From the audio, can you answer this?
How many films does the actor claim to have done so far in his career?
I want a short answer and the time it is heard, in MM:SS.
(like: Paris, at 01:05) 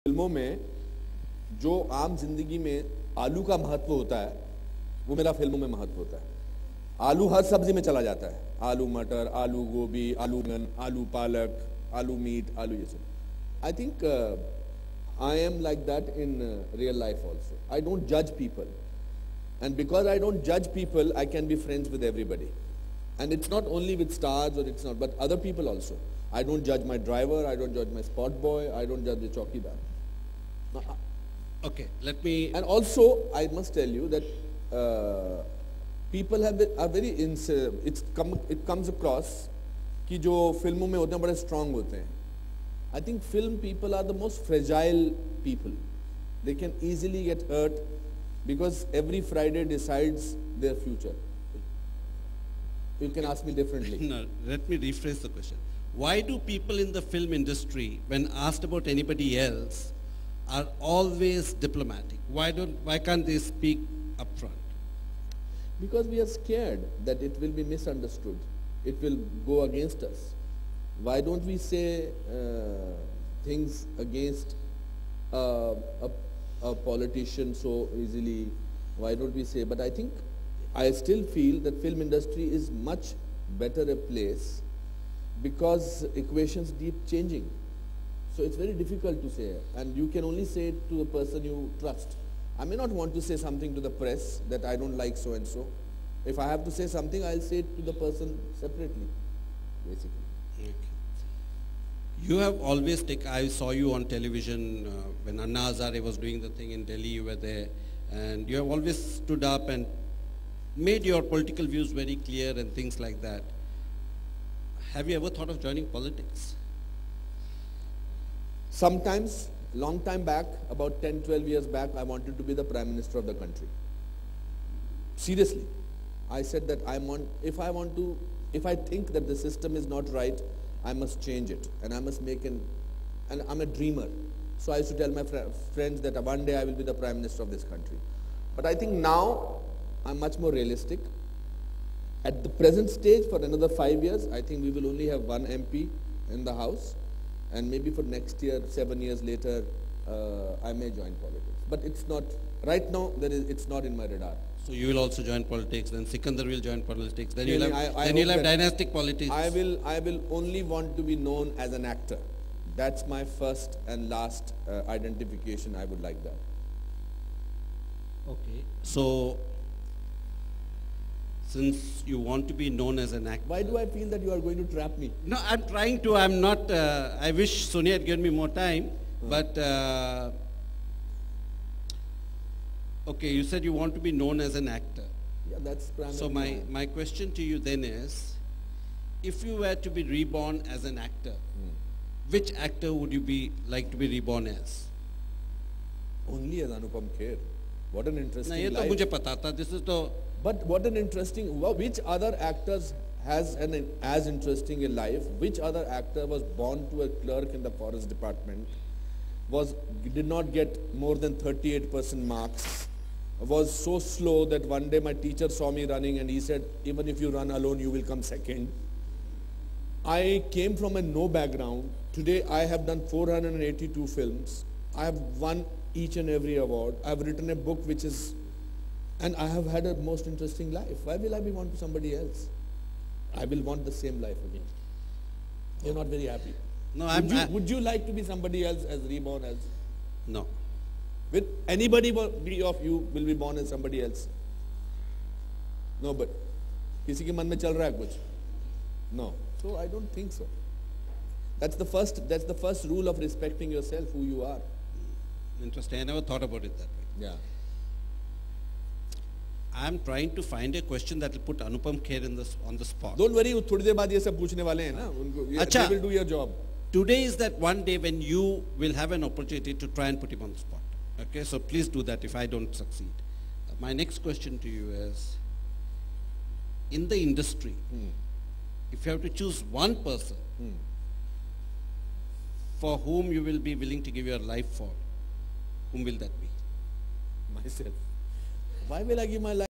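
482, at 03:43.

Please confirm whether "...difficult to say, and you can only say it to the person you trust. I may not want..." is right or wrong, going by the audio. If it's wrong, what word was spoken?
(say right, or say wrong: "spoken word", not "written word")
right.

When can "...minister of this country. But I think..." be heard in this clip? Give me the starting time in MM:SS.
02:17.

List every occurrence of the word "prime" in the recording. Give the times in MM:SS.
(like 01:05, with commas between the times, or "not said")
02:02, 02:16.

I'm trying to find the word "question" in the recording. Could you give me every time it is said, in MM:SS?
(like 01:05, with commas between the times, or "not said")
00:55, 03:06, 04:20, 04:34.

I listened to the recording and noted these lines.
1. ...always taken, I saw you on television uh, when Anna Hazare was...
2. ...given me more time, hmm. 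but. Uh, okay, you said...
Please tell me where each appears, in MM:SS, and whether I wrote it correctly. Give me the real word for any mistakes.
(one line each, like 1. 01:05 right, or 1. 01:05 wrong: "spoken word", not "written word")
1. 01:42 right
2. 02:58 right.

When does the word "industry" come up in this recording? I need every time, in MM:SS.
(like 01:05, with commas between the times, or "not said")
00:57, 01:22, 04:37.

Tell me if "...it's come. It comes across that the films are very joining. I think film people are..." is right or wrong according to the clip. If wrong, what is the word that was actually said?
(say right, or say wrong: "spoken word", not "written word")
wrong: "strong", not "joining".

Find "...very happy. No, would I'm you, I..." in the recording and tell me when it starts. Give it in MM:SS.
03:56.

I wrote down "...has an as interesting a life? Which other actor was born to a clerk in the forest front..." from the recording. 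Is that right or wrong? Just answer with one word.
wrong.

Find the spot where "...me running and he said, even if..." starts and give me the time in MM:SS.
03:35.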